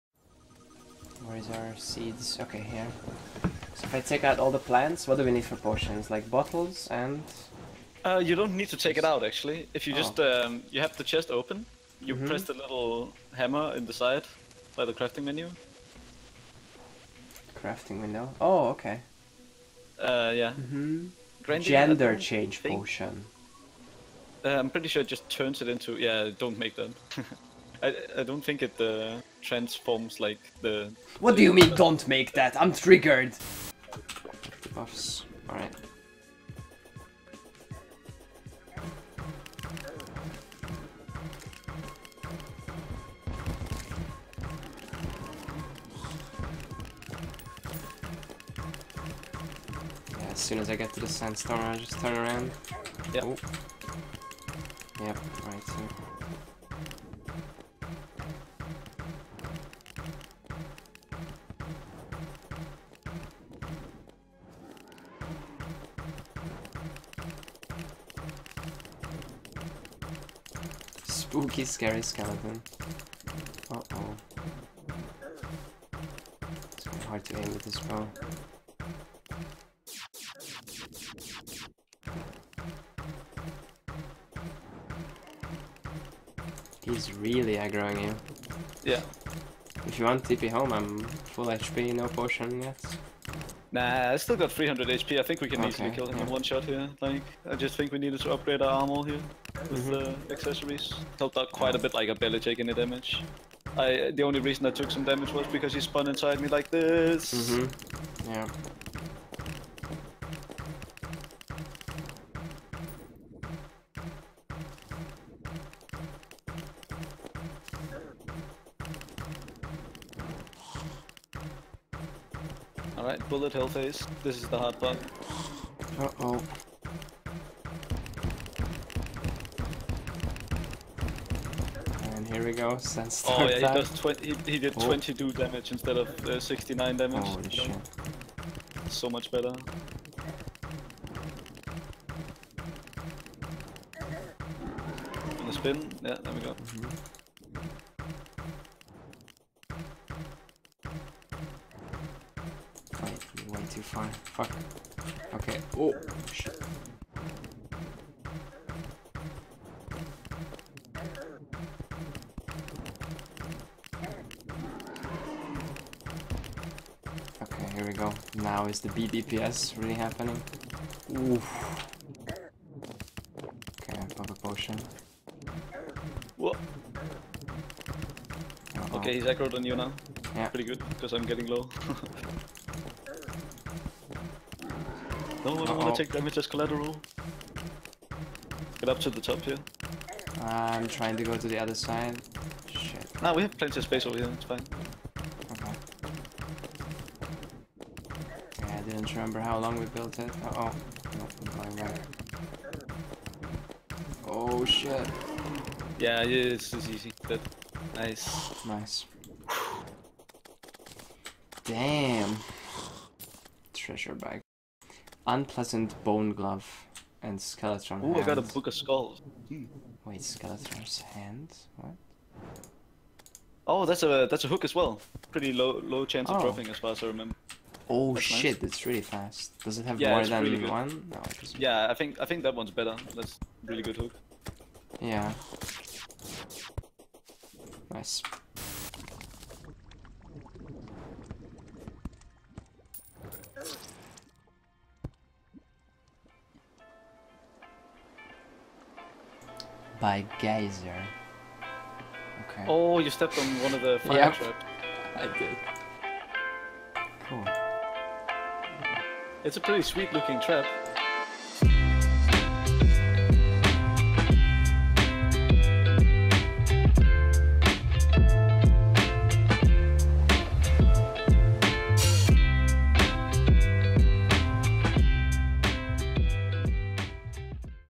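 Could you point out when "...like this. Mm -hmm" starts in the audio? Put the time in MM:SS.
01:46.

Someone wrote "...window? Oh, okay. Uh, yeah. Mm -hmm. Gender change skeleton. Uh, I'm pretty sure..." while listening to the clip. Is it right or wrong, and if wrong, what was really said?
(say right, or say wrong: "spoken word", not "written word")
wrong: "potion", not "skeleton".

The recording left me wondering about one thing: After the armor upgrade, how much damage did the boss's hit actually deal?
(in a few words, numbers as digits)
22.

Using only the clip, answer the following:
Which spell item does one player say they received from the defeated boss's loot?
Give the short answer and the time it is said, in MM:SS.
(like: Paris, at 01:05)
Book of Skulls, at 03:38.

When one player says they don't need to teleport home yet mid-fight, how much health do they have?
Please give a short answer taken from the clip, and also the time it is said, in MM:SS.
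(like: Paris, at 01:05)
300 HP, at 01:34.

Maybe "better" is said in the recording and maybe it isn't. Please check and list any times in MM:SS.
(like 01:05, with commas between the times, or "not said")
02:19, 03:52.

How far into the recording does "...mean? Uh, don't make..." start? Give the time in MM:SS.
00:31.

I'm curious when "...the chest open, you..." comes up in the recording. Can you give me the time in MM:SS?
00:10.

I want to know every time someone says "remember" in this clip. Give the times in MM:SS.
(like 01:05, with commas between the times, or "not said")
03:19, 03:47.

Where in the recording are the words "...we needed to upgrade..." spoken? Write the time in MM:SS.
01:37.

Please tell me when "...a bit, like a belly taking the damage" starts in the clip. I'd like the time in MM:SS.
01:41.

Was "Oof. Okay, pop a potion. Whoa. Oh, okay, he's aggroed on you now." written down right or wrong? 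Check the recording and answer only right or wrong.
right.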